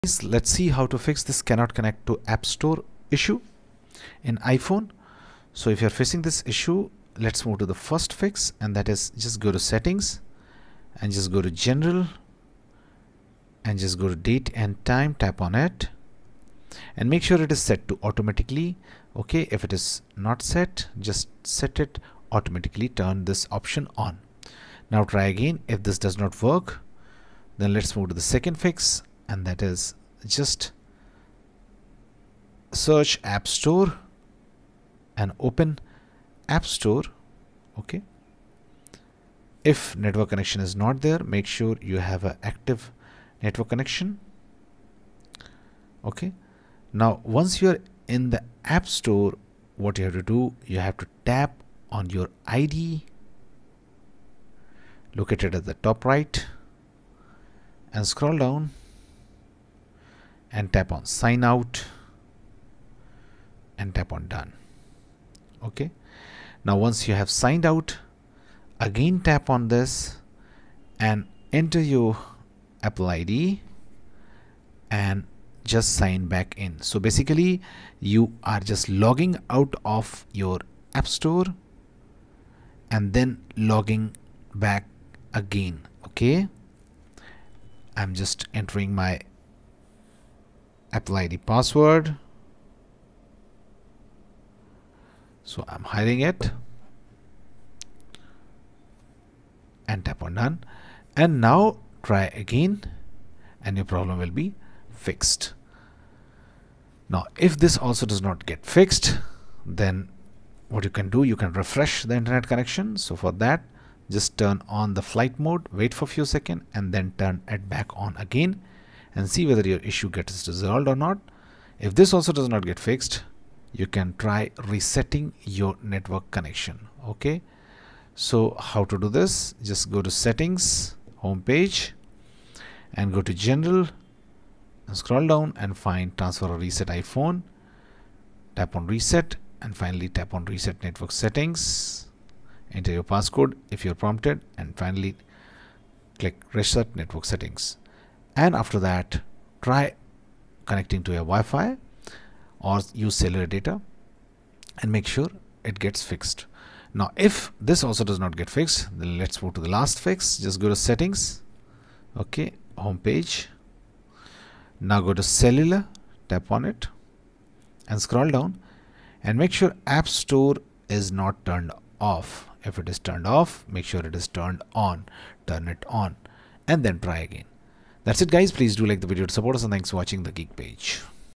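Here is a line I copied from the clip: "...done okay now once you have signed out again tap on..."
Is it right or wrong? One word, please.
right.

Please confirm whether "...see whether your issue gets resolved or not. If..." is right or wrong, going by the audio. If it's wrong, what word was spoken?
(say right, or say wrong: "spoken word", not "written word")
right.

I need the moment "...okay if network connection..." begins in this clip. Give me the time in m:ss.
0:37.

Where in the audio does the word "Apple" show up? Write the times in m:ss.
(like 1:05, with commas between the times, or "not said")
1:12, 1:30.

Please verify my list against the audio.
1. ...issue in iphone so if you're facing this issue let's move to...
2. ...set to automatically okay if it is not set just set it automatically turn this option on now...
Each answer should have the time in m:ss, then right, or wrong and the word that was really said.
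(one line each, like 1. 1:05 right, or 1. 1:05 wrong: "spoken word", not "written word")
1. 0:03 right
2. 0:17 right.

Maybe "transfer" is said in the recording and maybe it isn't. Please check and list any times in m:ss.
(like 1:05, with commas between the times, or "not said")
2:16.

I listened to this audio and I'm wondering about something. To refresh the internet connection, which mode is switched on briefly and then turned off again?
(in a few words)
Flight mode.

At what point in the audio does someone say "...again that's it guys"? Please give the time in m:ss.
2:57.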